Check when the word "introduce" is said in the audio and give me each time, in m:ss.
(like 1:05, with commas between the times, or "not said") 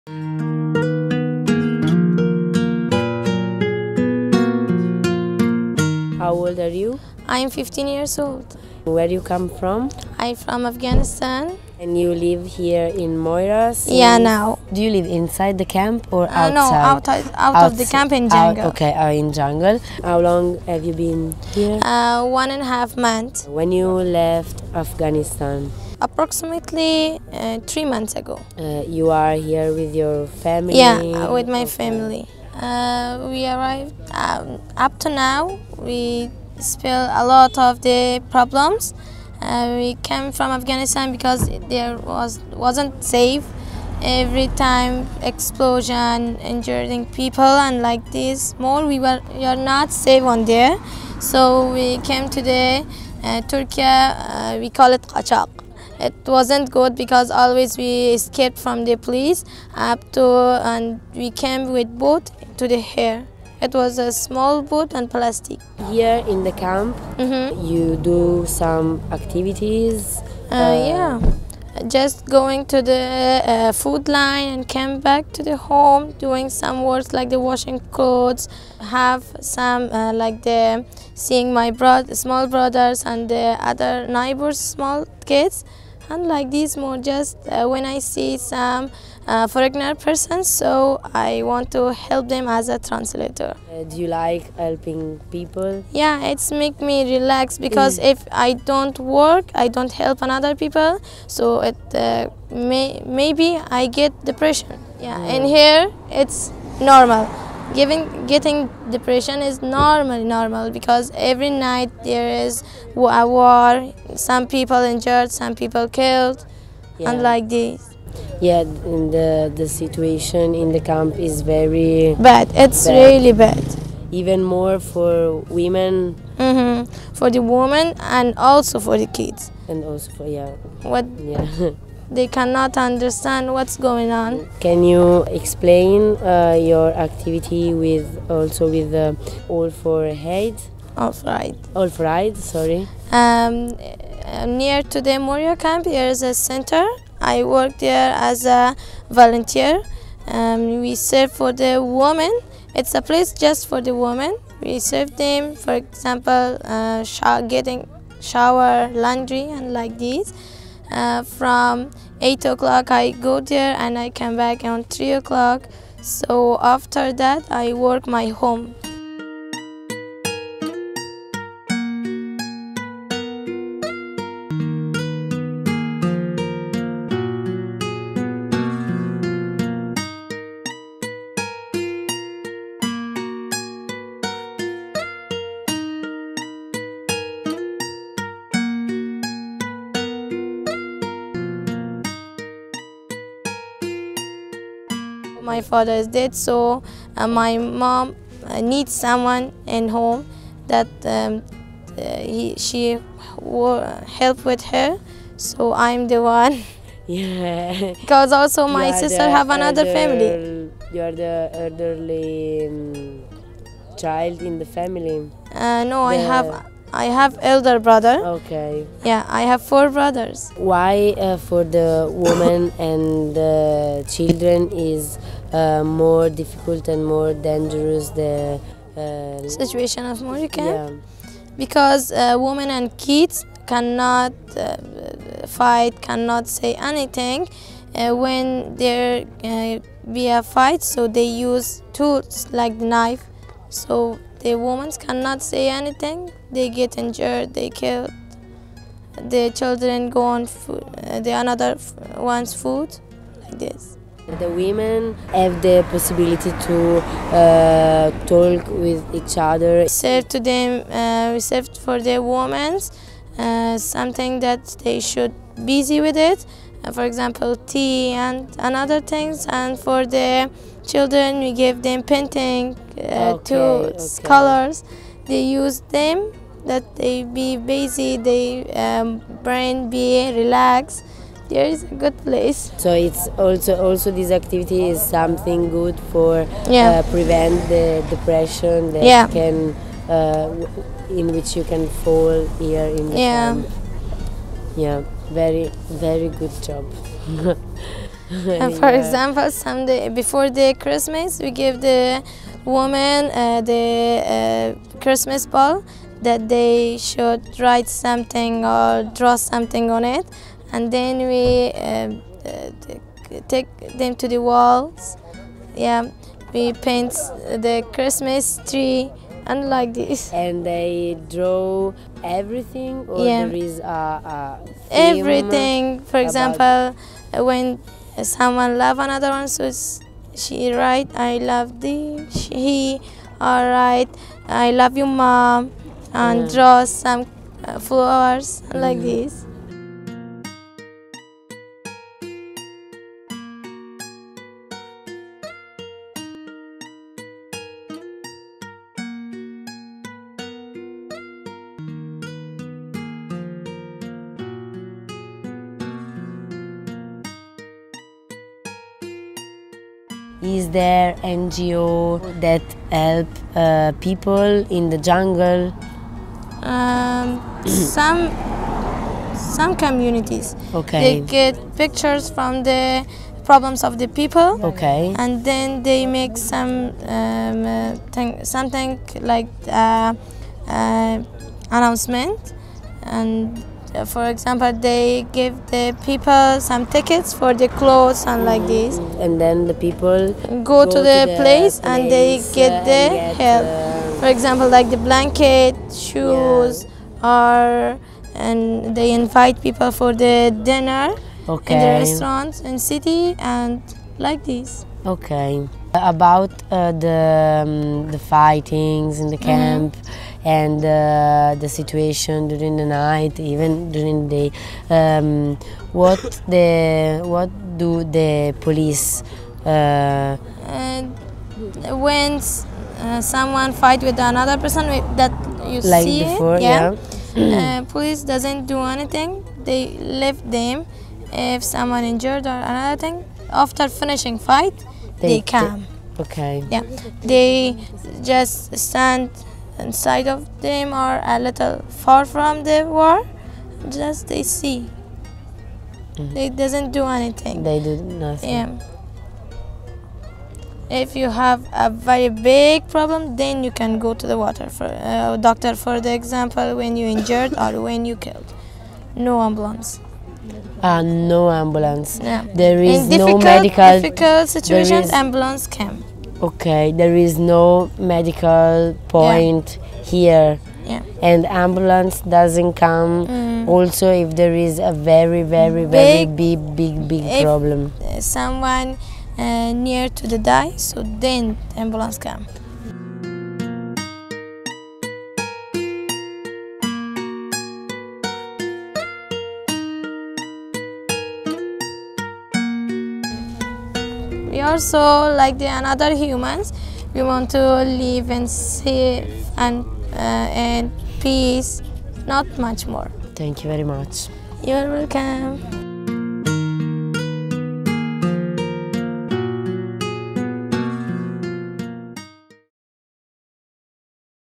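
not said.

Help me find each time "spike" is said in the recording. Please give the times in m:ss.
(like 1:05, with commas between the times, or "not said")
not said.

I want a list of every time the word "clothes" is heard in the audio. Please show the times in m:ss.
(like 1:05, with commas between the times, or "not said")
1:17, 6:27.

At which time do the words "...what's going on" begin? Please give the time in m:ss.
2:13.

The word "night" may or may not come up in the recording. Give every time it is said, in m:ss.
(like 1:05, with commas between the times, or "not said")
1:51, 6:52.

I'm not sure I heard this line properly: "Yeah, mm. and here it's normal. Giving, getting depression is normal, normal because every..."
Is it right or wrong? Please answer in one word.
right.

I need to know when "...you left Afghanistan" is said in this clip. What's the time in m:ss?
0:23.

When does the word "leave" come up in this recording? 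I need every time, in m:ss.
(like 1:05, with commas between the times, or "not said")
7:09.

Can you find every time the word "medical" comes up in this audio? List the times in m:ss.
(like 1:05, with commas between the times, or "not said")
7:43, 7:47.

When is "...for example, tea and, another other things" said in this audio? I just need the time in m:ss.
4:26.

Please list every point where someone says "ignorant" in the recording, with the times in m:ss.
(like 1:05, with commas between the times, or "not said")
1:29.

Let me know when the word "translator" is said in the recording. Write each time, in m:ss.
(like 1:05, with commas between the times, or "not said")
1:32.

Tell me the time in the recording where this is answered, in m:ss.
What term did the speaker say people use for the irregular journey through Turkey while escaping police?
0:55.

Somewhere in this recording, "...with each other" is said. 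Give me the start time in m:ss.
4:18.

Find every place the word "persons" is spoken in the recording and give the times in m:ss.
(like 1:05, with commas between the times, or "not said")
1:29, 7:04.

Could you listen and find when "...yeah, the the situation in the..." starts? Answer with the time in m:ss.
1:58.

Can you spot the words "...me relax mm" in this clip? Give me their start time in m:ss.
1:36.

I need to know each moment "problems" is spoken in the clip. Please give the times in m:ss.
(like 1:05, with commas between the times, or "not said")
0:38, 6:13, 7:32, 7:57.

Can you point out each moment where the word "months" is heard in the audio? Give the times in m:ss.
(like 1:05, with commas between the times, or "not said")
0:22, 0:27.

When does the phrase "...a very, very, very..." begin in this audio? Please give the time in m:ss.
7:54.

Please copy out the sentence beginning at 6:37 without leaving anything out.
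or and they invite people for the dinner okay.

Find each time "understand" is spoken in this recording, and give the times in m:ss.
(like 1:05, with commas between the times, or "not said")
2:12.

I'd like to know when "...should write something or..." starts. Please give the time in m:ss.
5:06.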